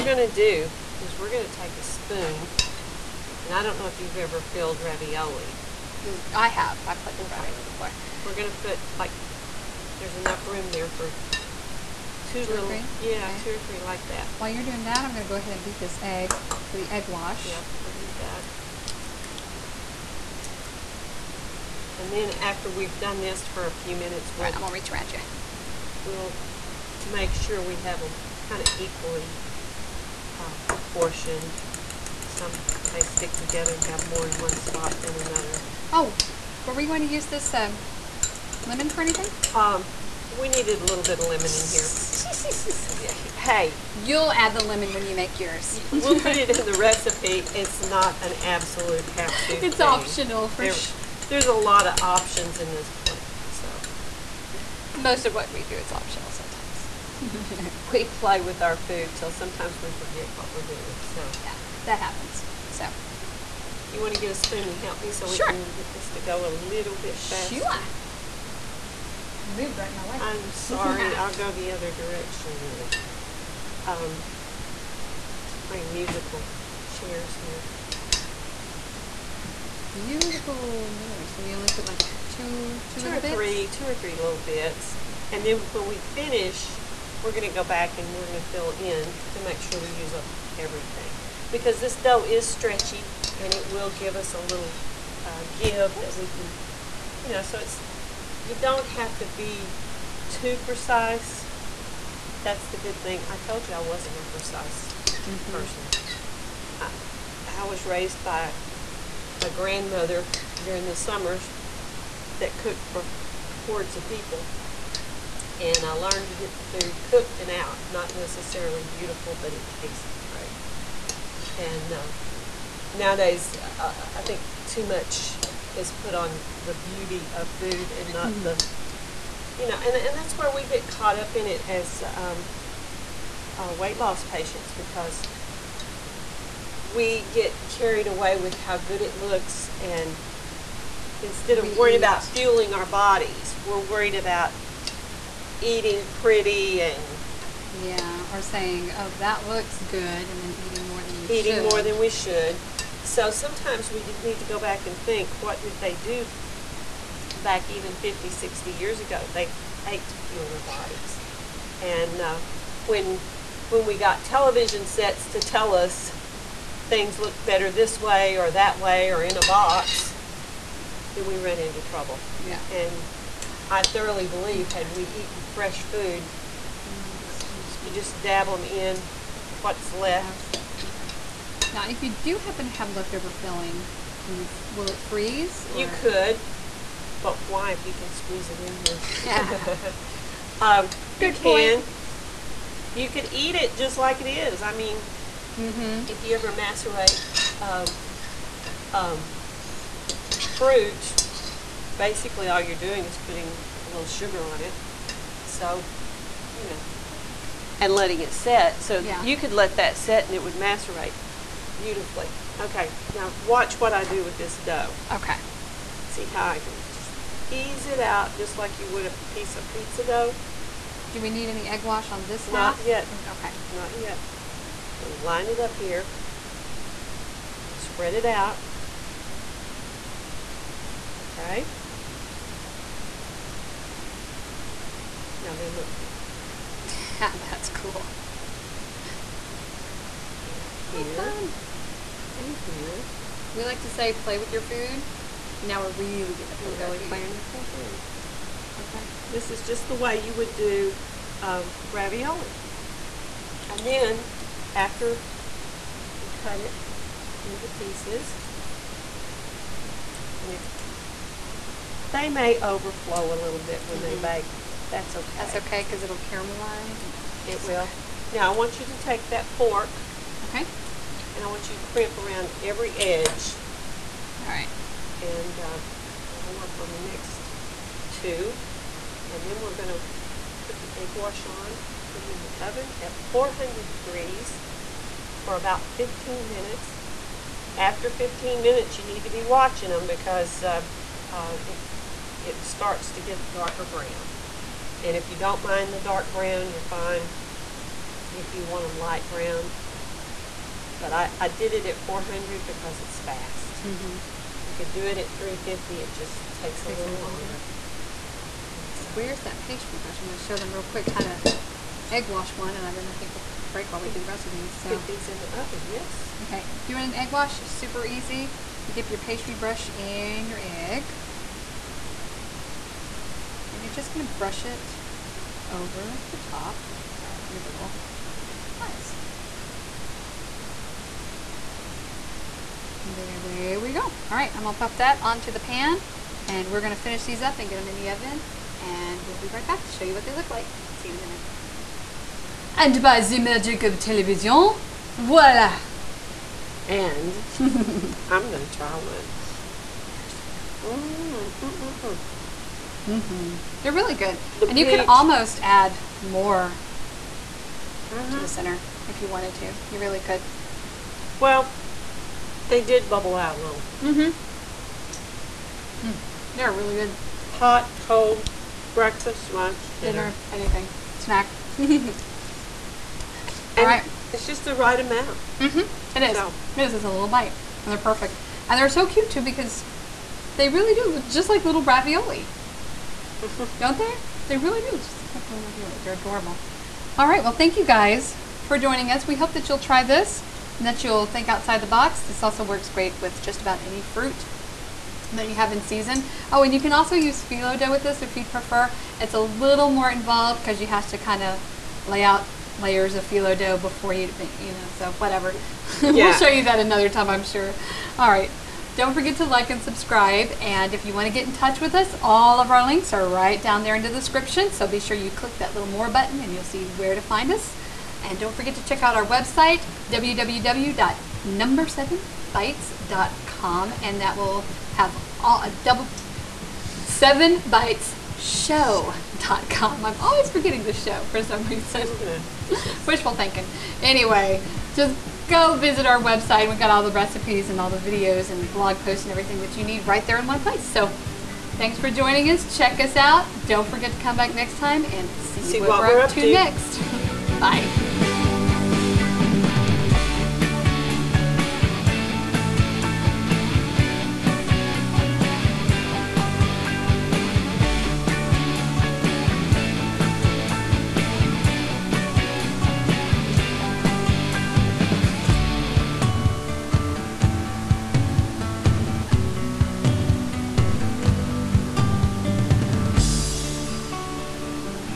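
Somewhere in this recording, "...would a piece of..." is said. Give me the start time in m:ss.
3:38.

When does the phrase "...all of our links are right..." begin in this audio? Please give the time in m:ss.
6:52.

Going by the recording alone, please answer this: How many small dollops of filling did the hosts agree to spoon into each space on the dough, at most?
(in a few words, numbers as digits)
3.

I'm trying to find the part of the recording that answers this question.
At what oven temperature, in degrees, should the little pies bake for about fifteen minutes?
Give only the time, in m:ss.
4:43.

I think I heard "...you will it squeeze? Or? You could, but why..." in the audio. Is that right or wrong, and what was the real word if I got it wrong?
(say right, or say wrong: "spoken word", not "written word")
wrong: "freeze", not "squeeze".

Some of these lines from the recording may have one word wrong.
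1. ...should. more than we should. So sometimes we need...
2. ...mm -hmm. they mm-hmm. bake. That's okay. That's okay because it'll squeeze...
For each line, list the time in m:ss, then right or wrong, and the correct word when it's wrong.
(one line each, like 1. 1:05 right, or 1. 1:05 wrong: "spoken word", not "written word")
1. 2:31 right
2. 4:23 wrong: "caramelize", not "squeeze".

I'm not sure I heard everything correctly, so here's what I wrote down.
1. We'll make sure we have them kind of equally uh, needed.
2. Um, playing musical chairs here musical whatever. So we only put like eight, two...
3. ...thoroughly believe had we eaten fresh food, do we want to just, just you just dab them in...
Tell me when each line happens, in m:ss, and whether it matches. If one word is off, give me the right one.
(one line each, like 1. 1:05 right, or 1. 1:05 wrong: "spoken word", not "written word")
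1. 0:26 wrong: "proportioned", not "needed"
2. 1:13 wrong: "two", not "eight"
3. 2:53 right.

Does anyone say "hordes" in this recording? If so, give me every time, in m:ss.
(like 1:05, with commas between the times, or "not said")
1:53.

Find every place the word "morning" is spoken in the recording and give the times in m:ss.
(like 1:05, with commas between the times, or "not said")
not said.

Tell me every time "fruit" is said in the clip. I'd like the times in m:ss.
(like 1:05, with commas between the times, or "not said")
3:20, 6:34.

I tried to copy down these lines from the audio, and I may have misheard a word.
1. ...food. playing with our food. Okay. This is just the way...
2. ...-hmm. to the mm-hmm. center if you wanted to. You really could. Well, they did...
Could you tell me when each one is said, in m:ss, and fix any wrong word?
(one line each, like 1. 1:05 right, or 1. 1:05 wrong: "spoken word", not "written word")
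1. 4:07 right
2. 5:56 right.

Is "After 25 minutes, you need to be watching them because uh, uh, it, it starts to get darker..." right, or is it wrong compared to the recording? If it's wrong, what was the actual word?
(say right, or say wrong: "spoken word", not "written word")
wrong: "15", not "25".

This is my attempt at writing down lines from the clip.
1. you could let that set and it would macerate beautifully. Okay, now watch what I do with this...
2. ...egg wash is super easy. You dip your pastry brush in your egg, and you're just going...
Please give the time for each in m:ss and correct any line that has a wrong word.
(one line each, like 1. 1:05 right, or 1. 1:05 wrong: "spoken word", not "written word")
1. 3:29 right
2. 5:17 right.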